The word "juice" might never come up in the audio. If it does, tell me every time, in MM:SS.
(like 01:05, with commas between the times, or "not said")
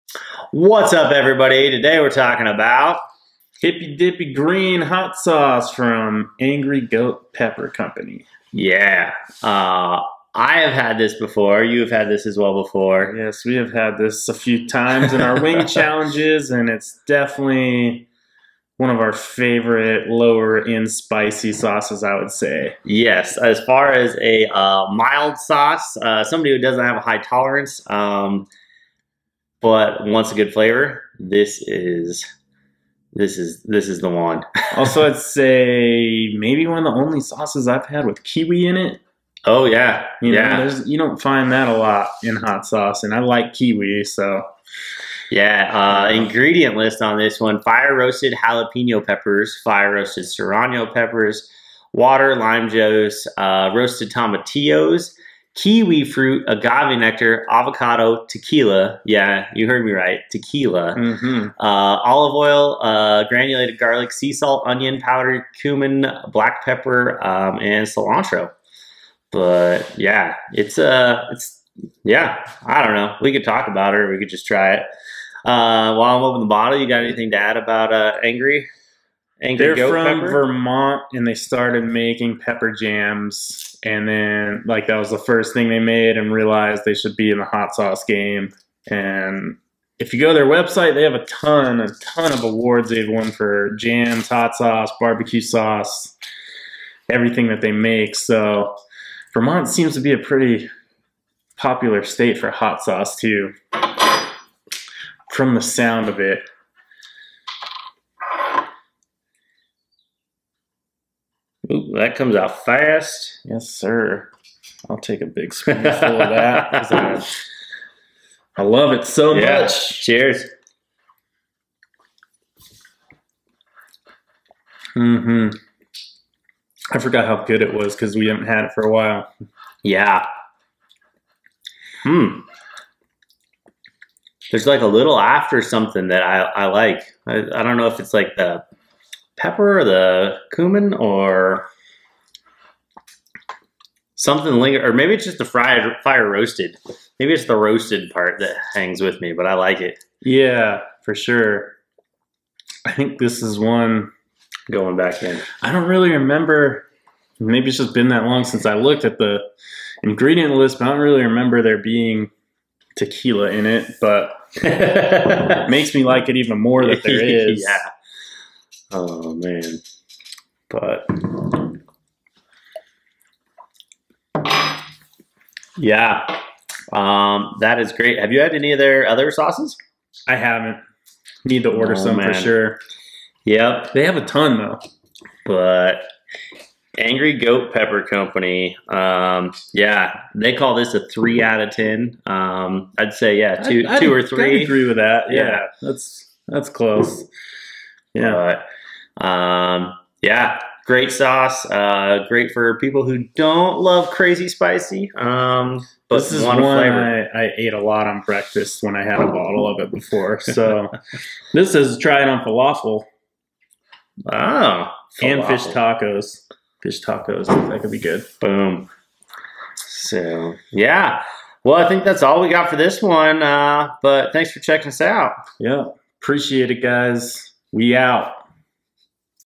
00:52.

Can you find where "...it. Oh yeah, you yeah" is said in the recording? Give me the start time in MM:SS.
00:38.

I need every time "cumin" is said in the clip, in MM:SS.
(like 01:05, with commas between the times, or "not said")
01:05, 02:20.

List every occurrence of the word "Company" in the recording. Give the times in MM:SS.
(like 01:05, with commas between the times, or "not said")
00:07, 03:08.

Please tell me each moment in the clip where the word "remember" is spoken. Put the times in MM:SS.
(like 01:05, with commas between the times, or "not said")
02:36, 02:41.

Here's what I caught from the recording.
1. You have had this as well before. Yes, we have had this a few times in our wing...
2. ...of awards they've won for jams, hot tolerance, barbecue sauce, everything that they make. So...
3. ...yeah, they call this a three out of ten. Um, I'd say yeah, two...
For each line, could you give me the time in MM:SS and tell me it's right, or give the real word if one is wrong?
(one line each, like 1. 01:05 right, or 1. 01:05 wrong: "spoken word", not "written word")
1. 00:11 right
2. 01:32 wrong: "sauce", not "tolerance"
3. 03:09 right.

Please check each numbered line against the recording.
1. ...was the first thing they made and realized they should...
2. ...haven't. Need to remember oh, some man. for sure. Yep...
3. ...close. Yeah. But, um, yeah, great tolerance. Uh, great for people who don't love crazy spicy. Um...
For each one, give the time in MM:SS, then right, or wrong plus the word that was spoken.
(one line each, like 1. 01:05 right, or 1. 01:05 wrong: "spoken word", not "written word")
1. 01:24 right
2. 03:00 wrong: "order", not "remember"
3. 03:16 wrong: "sauce", not "tolerance".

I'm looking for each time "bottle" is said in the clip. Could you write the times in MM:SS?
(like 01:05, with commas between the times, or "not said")
01:16, 03:29.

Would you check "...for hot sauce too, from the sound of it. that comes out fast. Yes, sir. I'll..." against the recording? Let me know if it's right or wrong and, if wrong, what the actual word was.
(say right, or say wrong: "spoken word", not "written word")
right.